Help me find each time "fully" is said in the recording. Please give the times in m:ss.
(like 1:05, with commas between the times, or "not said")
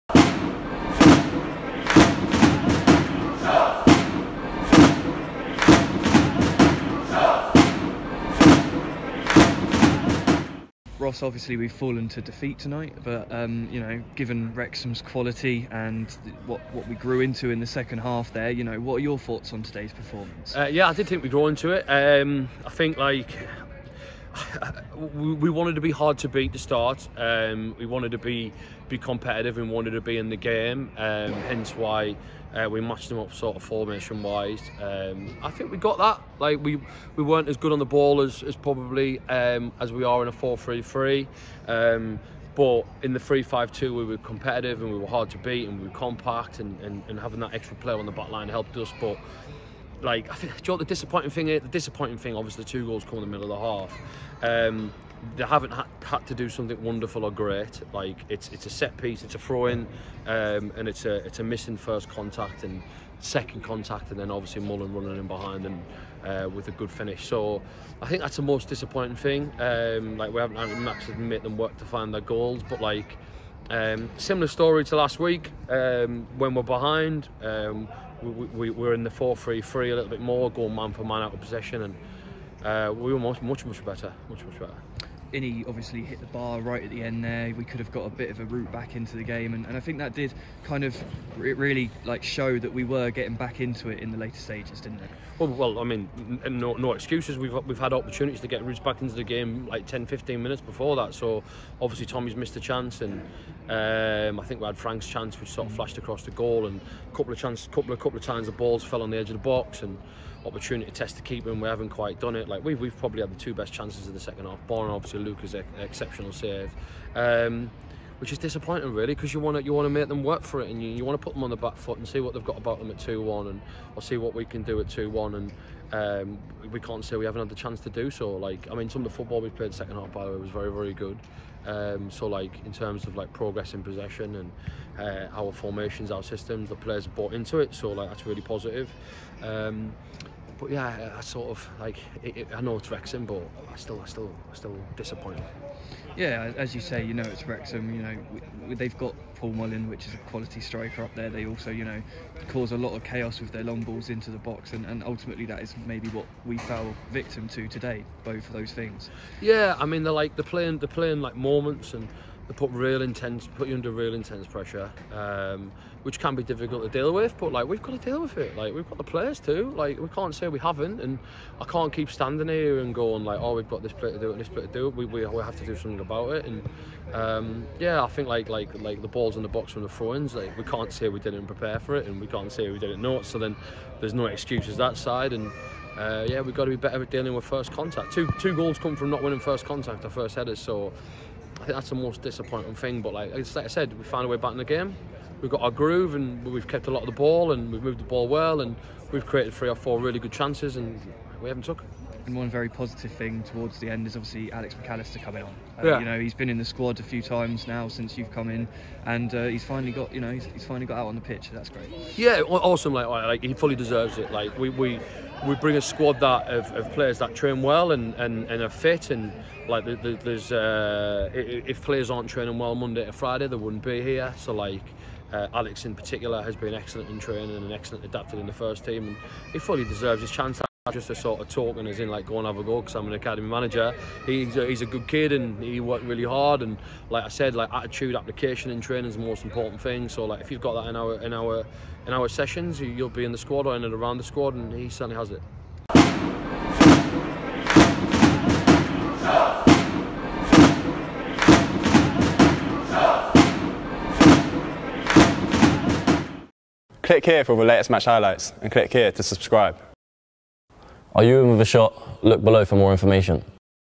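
3:33, 3:49.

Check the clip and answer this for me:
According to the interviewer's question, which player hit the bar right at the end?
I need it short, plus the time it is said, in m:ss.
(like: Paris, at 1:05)
Inny, at 1:25.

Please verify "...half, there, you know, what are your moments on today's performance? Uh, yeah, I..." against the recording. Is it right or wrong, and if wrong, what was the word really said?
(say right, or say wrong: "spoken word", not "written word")
wrong: "thoughts", not "moments".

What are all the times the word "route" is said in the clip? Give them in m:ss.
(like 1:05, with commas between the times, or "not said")
1:28, 1:38.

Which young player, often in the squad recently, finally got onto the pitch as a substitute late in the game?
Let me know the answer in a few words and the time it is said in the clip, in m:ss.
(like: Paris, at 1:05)
Alex McAllister, at 3:24.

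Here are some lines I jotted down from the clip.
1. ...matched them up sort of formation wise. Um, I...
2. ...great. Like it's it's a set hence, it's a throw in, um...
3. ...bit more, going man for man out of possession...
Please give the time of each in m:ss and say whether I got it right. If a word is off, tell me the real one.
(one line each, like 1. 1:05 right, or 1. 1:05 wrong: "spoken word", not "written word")
1. 0:32 right
2. 0:57 wrong: "piece", not "hence"
3. 1:20 right.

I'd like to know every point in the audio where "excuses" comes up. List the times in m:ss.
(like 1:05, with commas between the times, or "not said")
1:36, 3:04.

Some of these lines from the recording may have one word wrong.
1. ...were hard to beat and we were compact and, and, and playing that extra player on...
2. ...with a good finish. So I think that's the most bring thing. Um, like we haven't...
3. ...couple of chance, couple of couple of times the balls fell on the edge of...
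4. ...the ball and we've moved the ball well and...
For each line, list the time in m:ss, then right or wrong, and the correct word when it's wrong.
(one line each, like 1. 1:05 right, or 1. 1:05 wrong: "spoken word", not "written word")
1. 0:44 wrong: "having", not "playing"
2. 1:06 wrong: "disappointing", not "bring"
3. 1:47 right
4. 3:17 right.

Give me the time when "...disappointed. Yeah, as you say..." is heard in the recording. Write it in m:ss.
2:24.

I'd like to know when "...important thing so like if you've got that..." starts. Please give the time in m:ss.
3:59.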